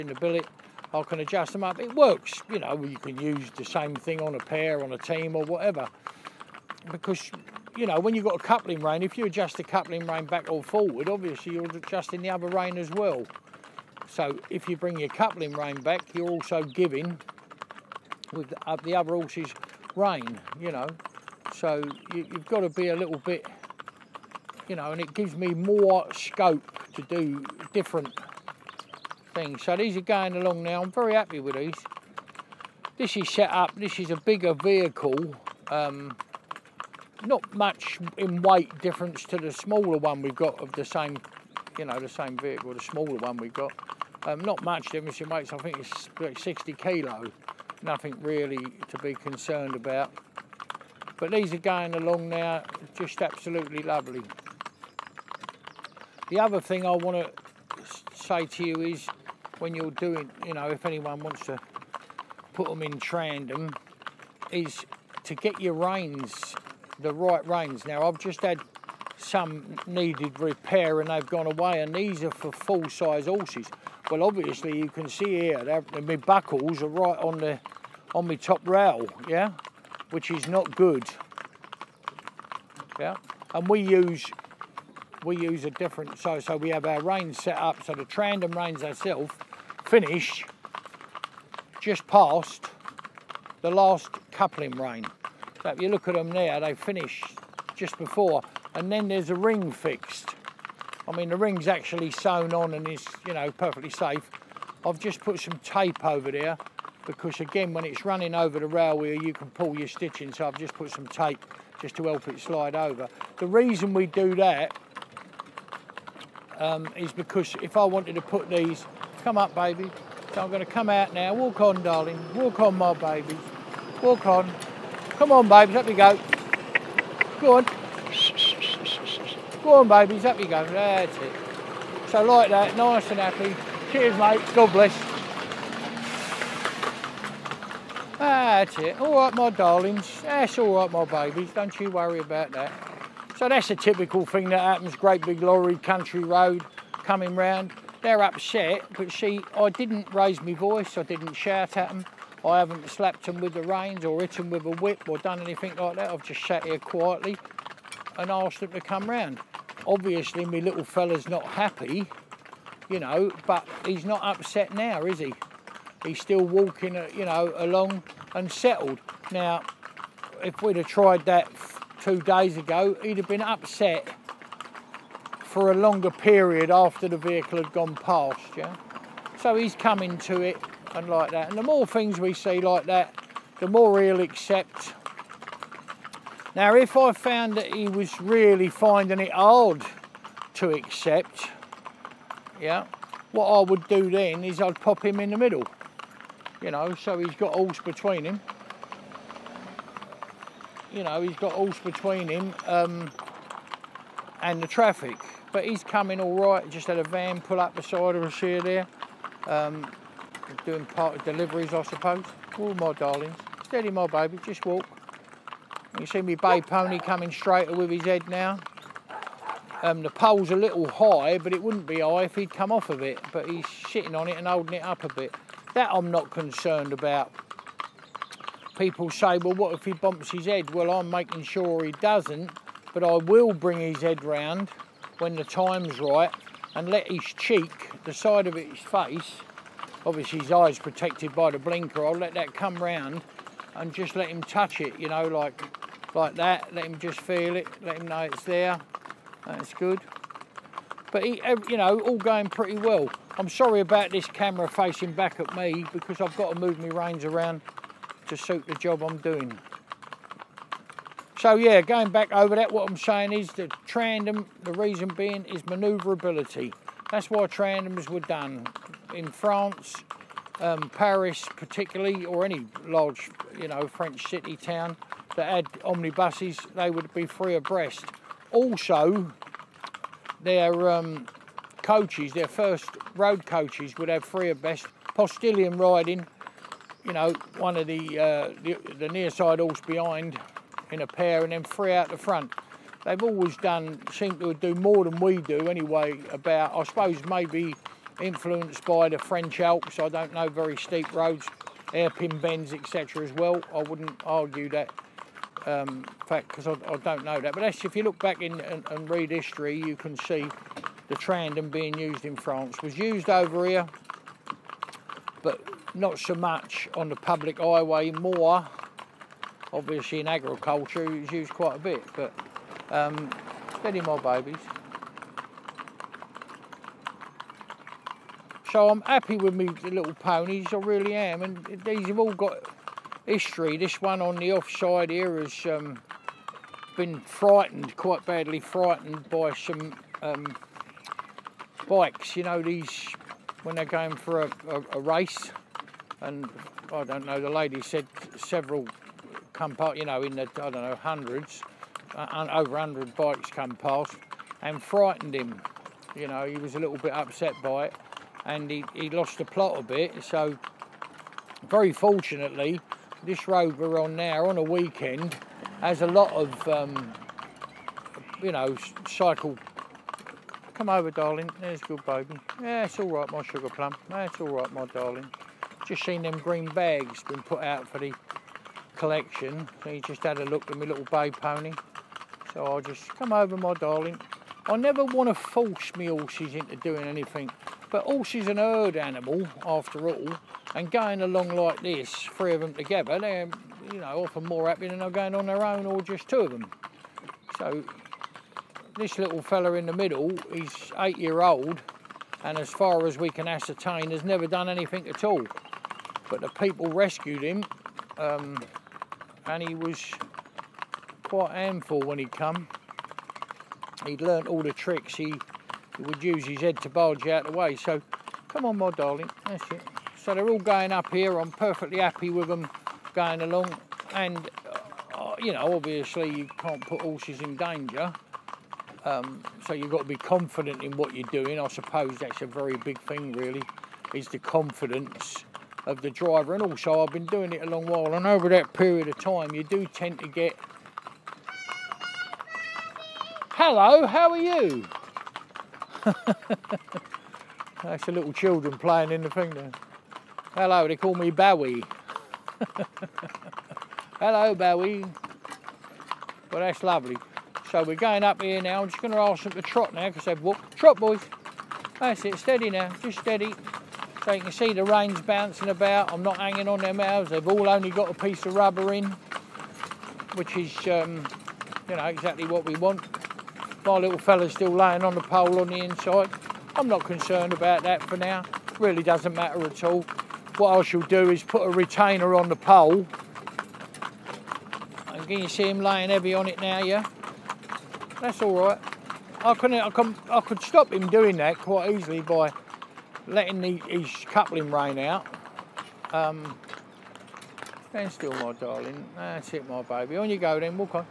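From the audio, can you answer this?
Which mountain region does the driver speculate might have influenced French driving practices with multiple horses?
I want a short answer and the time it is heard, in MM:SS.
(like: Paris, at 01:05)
French Alps, at 04:59.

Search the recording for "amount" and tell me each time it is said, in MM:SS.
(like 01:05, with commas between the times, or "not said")
not said.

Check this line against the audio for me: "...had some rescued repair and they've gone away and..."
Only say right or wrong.
wrong.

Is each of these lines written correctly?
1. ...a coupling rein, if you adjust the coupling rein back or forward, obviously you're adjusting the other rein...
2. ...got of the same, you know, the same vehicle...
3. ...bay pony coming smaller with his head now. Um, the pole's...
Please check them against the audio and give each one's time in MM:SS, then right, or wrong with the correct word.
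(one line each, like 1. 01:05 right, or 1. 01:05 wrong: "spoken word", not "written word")
1. 00:08 right
2. 00:40 right
3. 03:36 wrong: "straighter", not "smaller".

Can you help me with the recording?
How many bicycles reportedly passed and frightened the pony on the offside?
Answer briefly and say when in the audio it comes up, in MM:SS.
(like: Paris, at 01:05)
Over 100, at 05:52.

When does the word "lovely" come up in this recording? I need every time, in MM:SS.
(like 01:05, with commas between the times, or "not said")
00:53, 07:36.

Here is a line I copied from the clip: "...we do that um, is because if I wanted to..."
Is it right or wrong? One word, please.
right.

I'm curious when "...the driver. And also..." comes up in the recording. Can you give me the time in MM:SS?
07:16.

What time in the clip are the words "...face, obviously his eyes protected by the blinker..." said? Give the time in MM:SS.
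03:58.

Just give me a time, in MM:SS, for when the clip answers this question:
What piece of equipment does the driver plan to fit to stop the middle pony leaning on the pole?
08:01.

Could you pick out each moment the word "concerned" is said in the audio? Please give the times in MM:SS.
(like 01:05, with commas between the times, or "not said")
00:49, 03:46, 07:57.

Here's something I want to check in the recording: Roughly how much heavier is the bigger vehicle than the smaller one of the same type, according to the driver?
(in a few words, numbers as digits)
60 kilo.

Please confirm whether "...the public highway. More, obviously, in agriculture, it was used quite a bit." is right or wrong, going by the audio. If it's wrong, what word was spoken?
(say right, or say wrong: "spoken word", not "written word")
right.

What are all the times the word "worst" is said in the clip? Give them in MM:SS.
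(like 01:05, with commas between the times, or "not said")
not said.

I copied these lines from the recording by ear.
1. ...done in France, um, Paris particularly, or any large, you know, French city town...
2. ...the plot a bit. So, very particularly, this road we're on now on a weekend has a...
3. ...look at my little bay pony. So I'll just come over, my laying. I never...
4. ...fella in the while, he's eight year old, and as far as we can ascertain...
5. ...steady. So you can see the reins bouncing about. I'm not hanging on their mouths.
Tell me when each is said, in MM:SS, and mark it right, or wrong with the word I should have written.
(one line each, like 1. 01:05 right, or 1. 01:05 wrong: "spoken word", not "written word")
1. 04:28 right
2. 05:59 wrong: "fortunately", not "particularly"
3. 06:20 wrong: "darling", not "laying"
4. 06:39 wrong: "middle", not "while"
5. 07:43 right.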